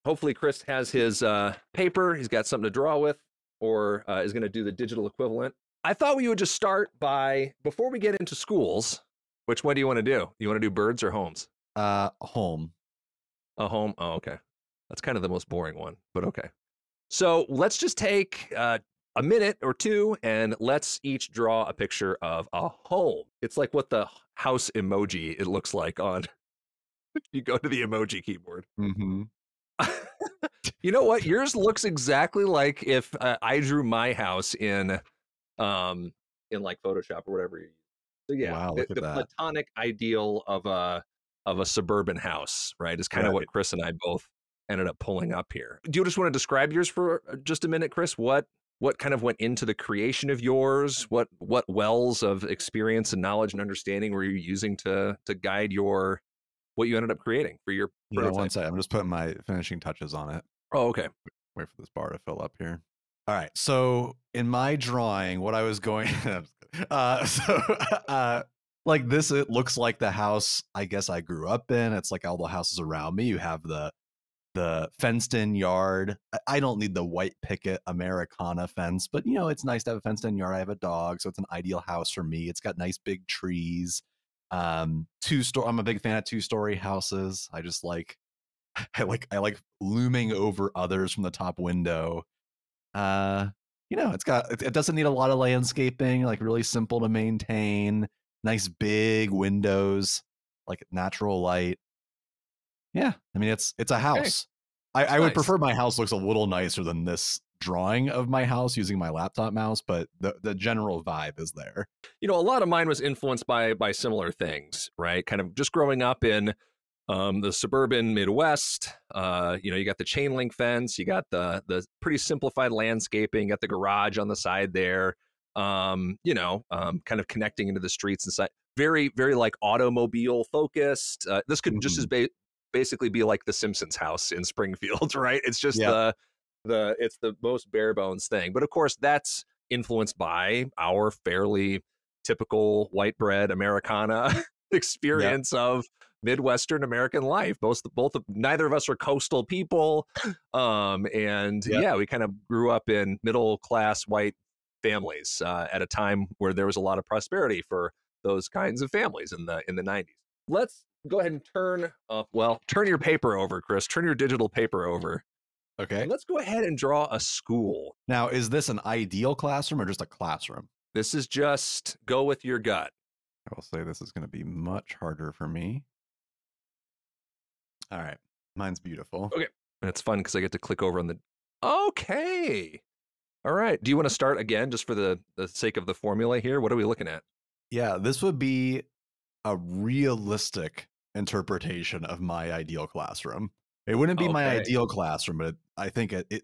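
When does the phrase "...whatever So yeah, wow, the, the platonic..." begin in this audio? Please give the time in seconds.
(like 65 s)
37 s.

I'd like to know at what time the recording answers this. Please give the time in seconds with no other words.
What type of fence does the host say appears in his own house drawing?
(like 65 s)
120 s.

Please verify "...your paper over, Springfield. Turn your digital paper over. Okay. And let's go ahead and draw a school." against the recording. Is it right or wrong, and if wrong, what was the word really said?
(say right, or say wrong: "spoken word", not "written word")
wrong: "Chris", not "Springfield".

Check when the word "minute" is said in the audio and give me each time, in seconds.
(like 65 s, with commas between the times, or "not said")
19 s, 47 s.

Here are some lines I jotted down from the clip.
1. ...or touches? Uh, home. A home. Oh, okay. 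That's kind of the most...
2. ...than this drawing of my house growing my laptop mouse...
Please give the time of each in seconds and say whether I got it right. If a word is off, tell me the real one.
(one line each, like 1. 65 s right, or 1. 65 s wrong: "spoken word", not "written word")
1. 11 s wrong: "homes", not "touches"
2. 106 s wrong: "using", not "growing".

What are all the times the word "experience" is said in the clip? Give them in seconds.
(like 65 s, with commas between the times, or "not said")
52 s, 144 s.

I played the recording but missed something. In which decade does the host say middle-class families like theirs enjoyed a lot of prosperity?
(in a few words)
The 90s.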